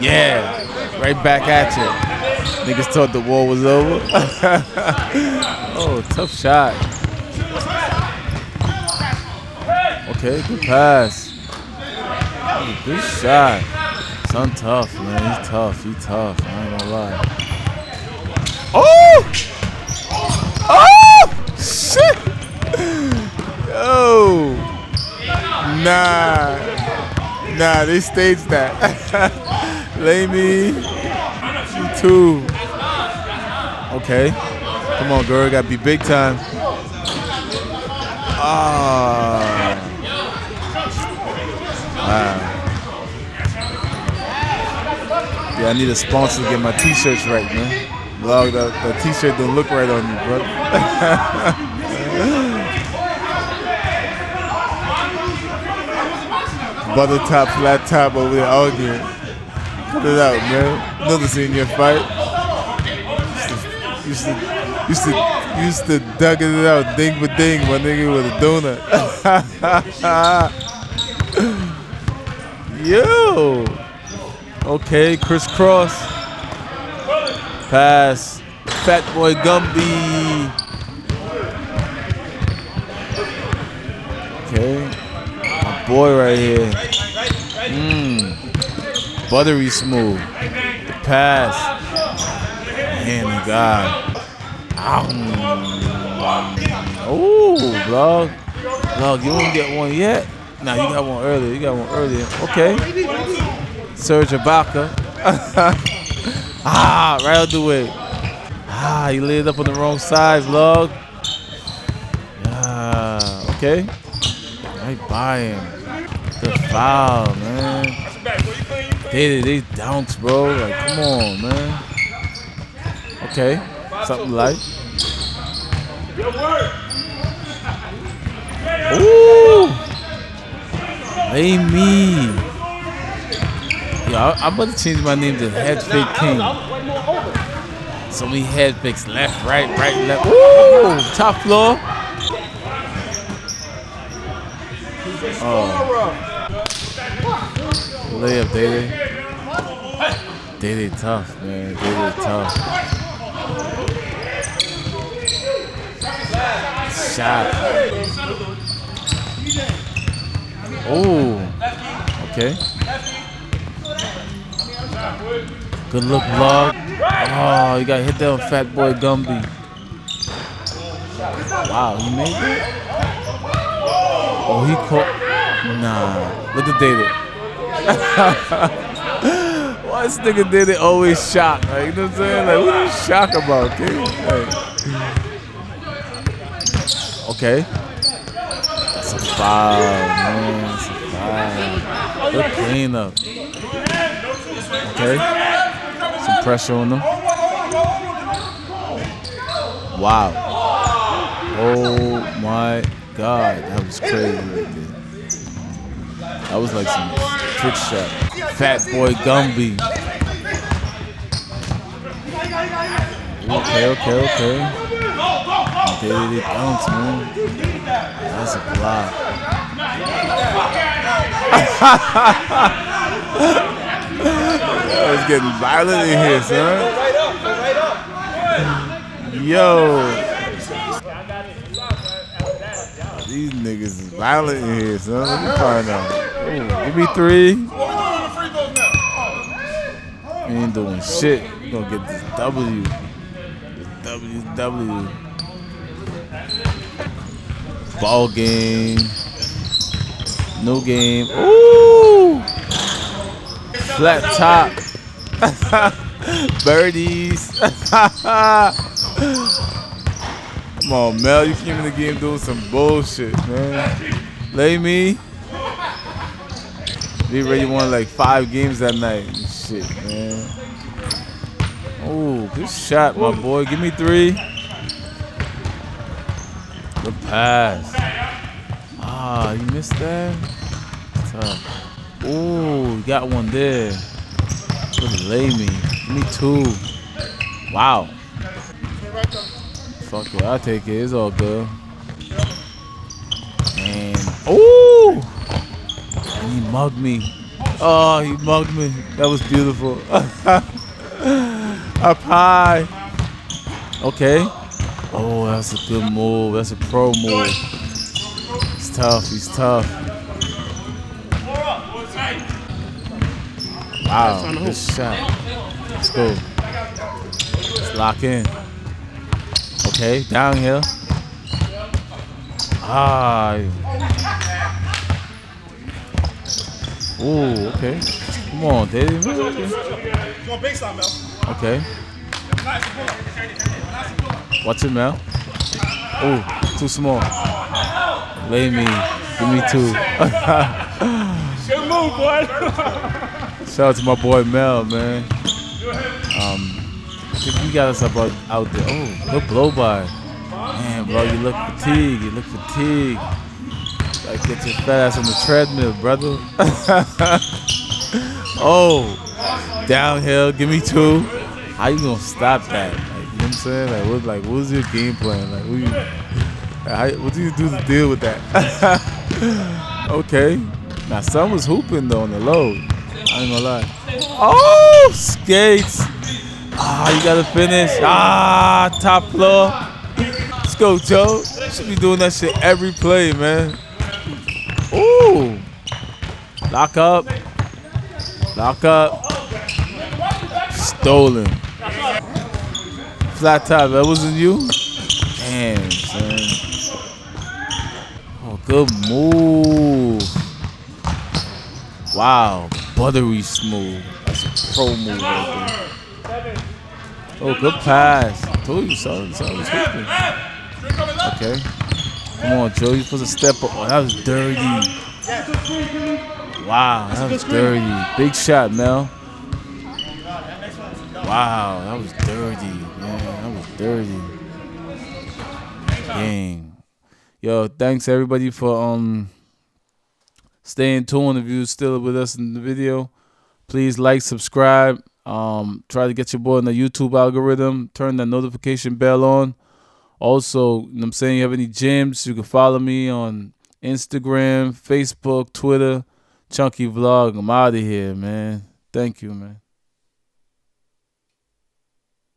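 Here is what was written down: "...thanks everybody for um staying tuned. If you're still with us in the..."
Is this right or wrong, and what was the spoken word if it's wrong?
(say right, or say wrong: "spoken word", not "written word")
right.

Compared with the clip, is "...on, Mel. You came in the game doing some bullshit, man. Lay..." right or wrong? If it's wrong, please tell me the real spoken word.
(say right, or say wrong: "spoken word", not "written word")
right.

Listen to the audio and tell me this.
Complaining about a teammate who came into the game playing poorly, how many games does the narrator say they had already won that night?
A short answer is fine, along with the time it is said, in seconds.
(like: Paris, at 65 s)
5, at 268 s.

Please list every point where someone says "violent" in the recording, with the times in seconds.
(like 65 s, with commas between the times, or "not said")
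225 s, 234 s.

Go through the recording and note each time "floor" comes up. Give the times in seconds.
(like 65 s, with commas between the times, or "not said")
141 s, 379 s.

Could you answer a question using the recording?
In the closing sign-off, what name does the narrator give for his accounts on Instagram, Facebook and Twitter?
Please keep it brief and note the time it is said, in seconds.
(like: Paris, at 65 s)
Chunky Vlog, at 446 s.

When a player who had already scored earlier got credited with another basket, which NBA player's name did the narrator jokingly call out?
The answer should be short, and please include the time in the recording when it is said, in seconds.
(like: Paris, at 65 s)
Serge Ibaka, at 103 s.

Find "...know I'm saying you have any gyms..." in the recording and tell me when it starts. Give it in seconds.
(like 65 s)
440 s.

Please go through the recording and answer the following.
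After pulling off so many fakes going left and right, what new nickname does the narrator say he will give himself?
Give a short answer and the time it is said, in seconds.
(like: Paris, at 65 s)
Headfake King, at 135 s.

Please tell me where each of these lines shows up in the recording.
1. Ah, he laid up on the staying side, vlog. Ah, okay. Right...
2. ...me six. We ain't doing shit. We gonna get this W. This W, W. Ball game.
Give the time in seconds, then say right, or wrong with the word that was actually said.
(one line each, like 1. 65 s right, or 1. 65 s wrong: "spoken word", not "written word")
1. 107 s wrong: "wrong", not "staying"
2. 236 s wrong: "three", not "six".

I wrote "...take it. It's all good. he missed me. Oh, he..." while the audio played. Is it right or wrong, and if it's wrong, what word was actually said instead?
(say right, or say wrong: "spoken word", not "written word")
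wrong: "mugged", not "missed".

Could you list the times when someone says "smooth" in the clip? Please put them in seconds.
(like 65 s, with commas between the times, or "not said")
89 s, 403 s.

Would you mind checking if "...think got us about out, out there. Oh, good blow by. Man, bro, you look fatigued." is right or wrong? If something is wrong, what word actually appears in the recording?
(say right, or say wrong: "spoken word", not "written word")
right.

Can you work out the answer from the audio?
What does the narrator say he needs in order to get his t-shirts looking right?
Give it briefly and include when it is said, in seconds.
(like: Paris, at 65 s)
A sponsor, at 45 s.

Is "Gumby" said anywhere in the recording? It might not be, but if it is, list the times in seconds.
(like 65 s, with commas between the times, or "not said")
79 s, 168 s, 209 s.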